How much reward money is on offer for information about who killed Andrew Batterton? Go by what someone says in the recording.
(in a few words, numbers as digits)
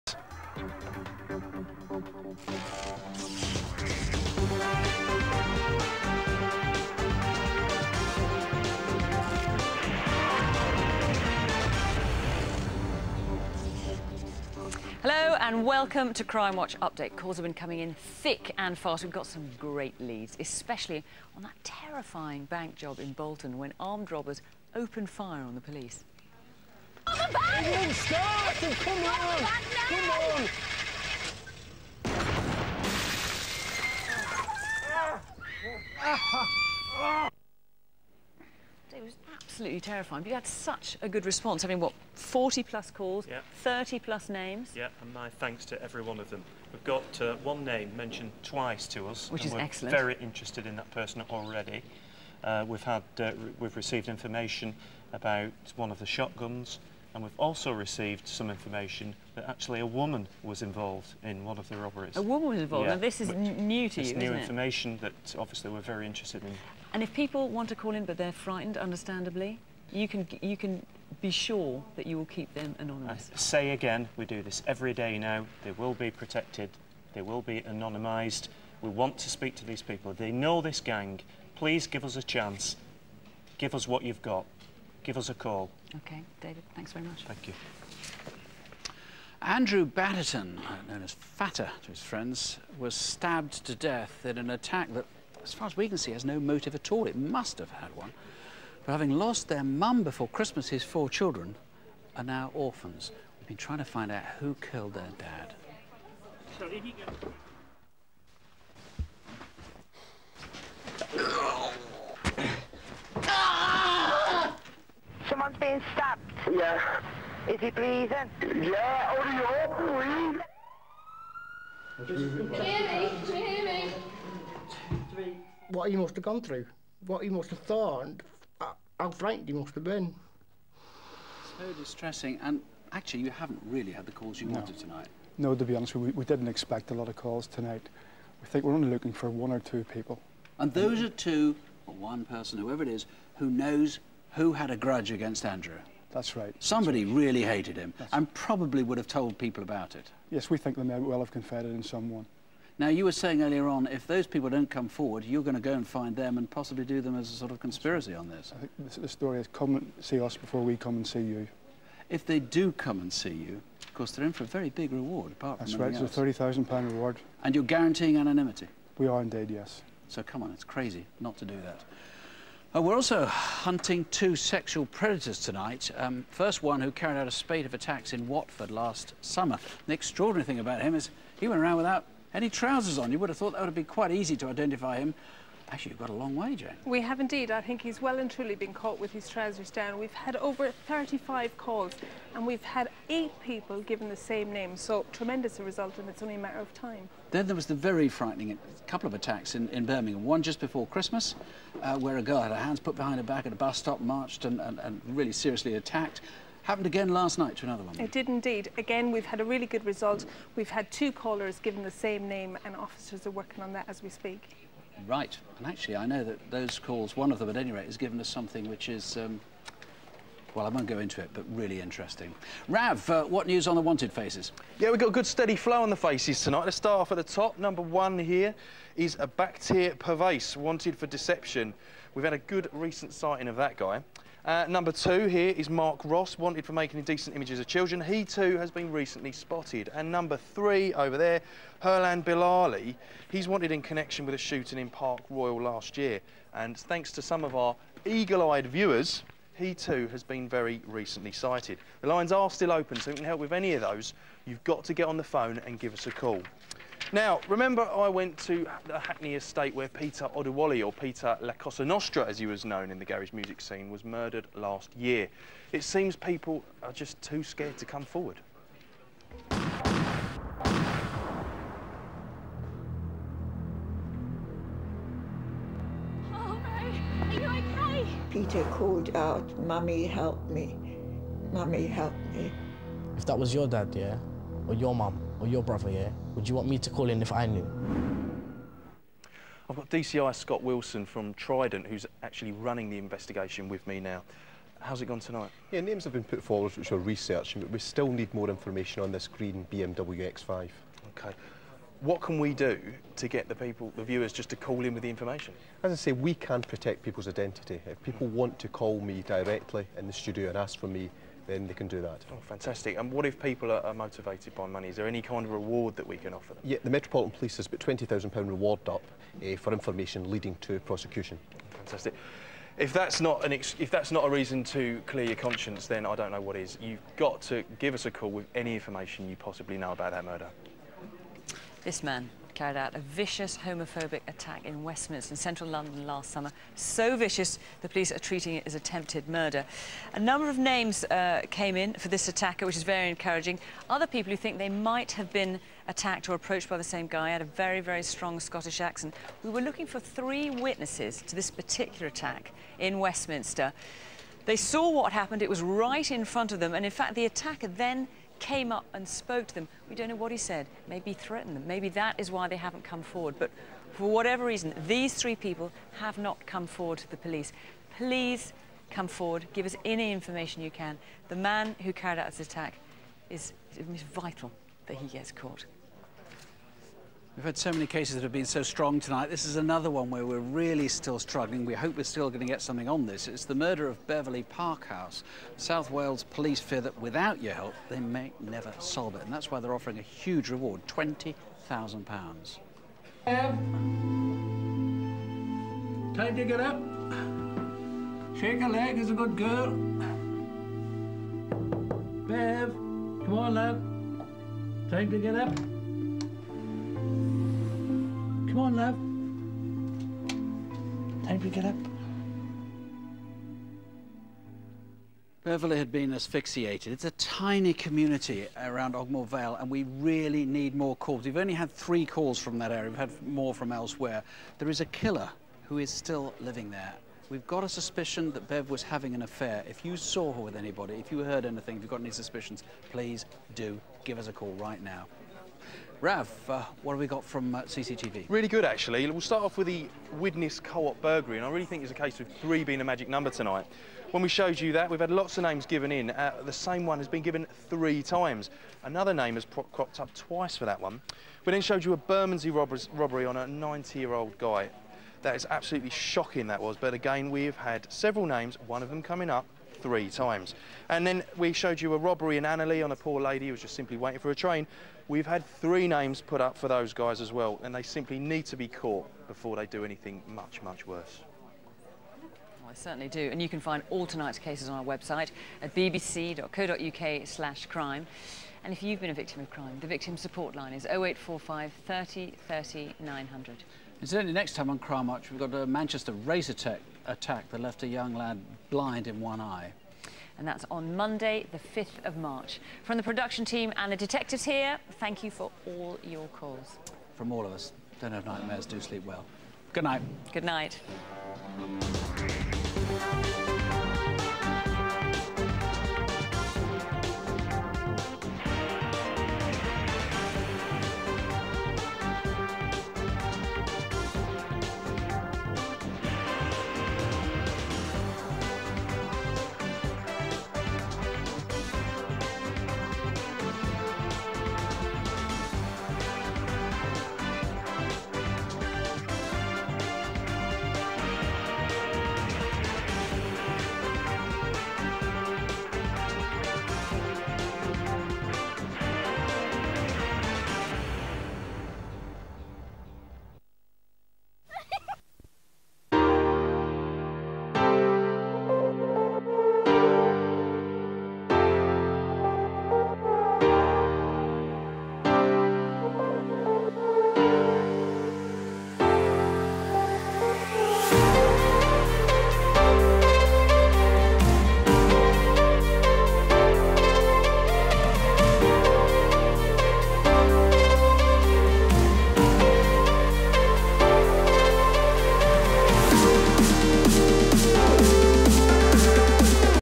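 £30,000.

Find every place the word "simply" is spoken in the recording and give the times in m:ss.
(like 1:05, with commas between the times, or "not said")
7:43, 7:47.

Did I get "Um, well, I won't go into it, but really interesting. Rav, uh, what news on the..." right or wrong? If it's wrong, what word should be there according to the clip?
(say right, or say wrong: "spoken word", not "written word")
right.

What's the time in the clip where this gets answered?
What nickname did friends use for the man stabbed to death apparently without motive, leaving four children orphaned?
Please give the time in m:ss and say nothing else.
1:31.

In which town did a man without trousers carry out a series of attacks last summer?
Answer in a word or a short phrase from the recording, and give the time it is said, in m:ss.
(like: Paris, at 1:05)
Watford, at 2:58.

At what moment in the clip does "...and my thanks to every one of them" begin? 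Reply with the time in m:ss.
0:45.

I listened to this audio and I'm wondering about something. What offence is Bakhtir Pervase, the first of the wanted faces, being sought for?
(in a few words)
Deception.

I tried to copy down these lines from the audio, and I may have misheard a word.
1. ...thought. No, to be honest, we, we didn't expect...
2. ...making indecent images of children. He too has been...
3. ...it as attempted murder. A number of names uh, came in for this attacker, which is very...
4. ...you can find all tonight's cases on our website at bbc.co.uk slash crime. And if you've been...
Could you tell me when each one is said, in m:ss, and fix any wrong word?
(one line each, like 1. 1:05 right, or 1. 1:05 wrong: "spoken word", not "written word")
1. 2:14 wrong: "tonight", not "thought"
2. 3:56 right
3. 5:38 right
4. 7:53 right.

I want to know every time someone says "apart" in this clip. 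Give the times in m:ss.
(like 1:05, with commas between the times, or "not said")
2:45.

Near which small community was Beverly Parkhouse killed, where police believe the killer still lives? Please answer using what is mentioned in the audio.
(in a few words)
Ogmore Vale.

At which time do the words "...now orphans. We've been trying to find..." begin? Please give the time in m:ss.
1:42.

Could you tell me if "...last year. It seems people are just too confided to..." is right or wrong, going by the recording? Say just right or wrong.
wrong.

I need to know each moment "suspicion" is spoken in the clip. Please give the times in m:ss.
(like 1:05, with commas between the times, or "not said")
7:07, 7:12.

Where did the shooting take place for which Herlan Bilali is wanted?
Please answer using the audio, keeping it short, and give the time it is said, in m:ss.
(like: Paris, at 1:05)
Park Royal, at 4:04.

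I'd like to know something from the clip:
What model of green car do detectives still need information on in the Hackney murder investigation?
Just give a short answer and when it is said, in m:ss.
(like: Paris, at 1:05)
BMW X5, at 4:59.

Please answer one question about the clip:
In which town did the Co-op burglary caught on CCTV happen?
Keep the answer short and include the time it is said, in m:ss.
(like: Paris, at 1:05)
Widnes, at 7:20.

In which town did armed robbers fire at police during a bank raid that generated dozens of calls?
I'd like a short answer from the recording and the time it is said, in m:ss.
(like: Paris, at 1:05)
Bolton, at 0:23.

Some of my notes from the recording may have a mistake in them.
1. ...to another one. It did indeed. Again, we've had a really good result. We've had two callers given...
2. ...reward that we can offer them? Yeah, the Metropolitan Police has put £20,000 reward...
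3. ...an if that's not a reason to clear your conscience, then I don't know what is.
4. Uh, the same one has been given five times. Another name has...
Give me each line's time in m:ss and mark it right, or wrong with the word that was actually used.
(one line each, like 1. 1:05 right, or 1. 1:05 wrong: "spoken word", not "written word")
1. 3:27 right
2. 5:15 right
3. 5:23 right
4. 7:26 wrong: "three", not "five".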